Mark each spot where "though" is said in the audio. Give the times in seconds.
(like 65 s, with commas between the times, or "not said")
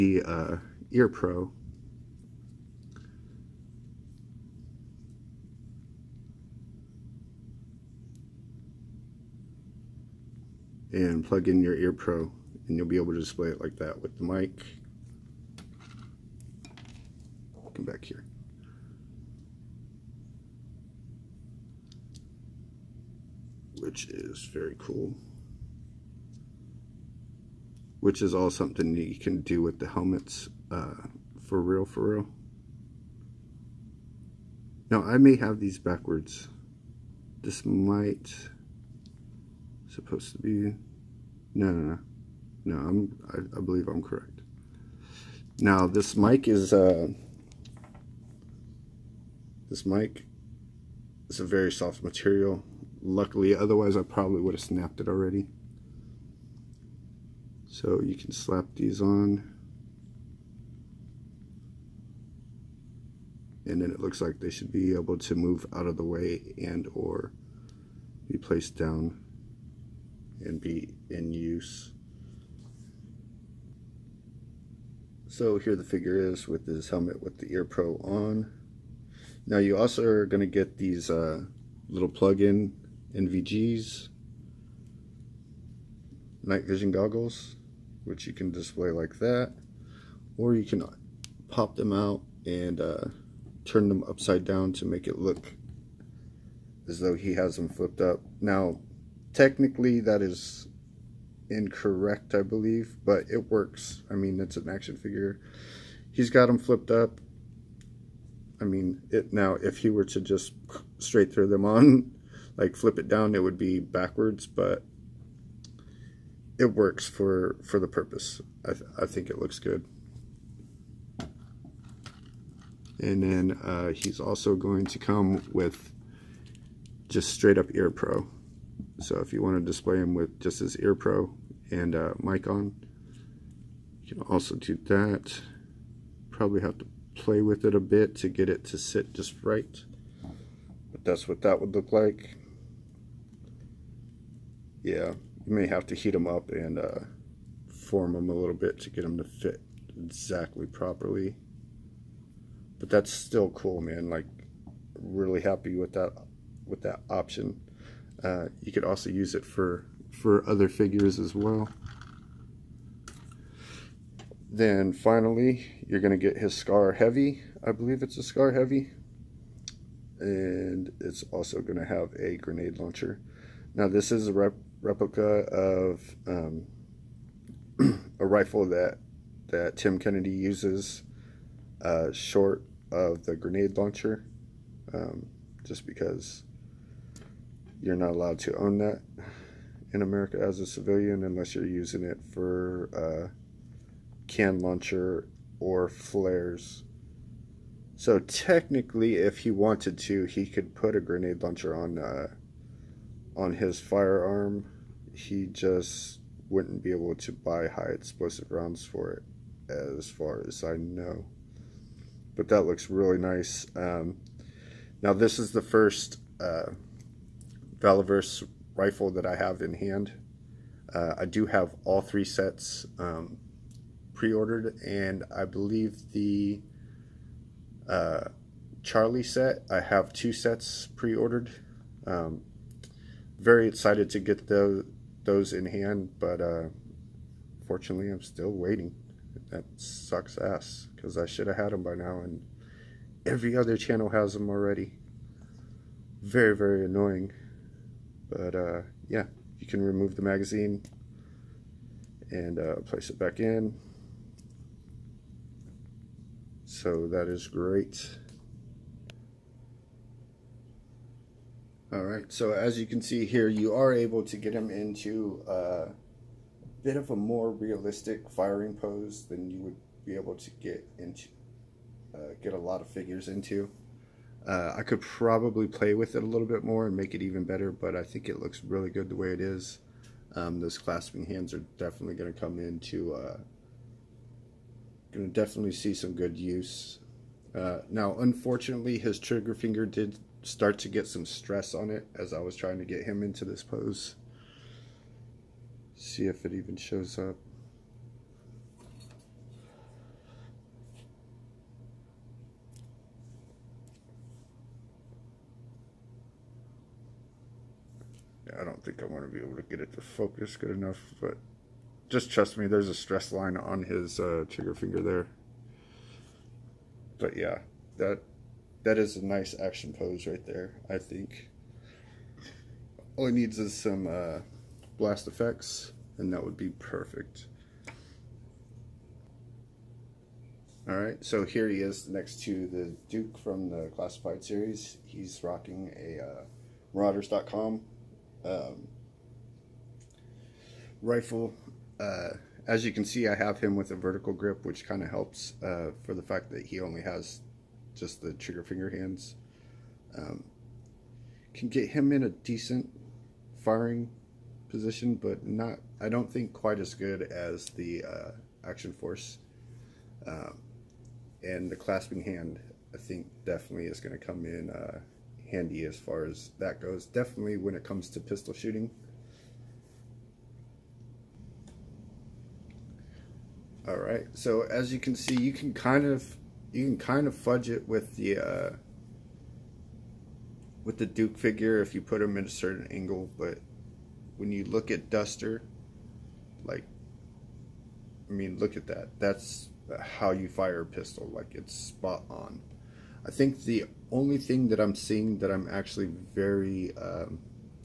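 96 s.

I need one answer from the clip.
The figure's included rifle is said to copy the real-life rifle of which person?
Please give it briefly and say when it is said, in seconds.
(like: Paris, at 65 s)
Tim Kennedy, at 179 s.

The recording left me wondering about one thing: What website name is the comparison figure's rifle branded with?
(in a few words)
Marauders.com.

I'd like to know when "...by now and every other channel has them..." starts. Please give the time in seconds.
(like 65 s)
241 s.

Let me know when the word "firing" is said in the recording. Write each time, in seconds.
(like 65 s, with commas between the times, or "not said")
268 s, 353 s.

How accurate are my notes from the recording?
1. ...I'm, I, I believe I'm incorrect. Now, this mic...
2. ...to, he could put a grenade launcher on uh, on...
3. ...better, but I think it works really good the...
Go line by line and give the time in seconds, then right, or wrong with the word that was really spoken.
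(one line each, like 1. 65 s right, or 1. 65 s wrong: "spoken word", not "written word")
1. 42 s wrong: "correct", not "incorrect"
2. 199 s right
3. 277 s wrong: "looks", not "works".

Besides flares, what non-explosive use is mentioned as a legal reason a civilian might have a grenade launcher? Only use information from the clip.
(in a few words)
can launcher.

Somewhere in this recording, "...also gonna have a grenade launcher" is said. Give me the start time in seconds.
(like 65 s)
171 s.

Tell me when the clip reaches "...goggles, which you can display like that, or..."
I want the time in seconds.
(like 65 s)
86 s.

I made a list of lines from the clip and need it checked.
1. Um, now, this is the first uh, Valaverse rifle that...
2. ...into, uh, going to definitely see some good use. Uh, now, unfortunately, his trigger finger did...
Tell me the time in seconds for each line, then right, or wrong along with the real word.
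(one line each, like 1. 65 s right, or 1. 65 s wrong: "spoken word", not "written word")
1. 213 s right
2. 282 s right.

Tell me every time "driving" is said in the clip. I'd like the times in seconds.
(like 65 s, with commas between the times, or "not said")
not said.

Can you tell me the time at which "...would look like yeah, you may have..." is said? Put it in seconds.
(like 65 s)
141 s.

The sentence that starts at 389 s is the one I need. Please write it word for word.
That's how you fire a pistol.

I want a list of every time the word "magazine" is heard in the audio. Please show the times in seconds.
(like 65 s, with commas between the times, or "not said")
250 s.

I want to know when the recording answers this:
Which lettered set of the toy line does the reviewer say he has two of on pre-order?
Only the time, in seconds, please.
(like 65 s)
228 s.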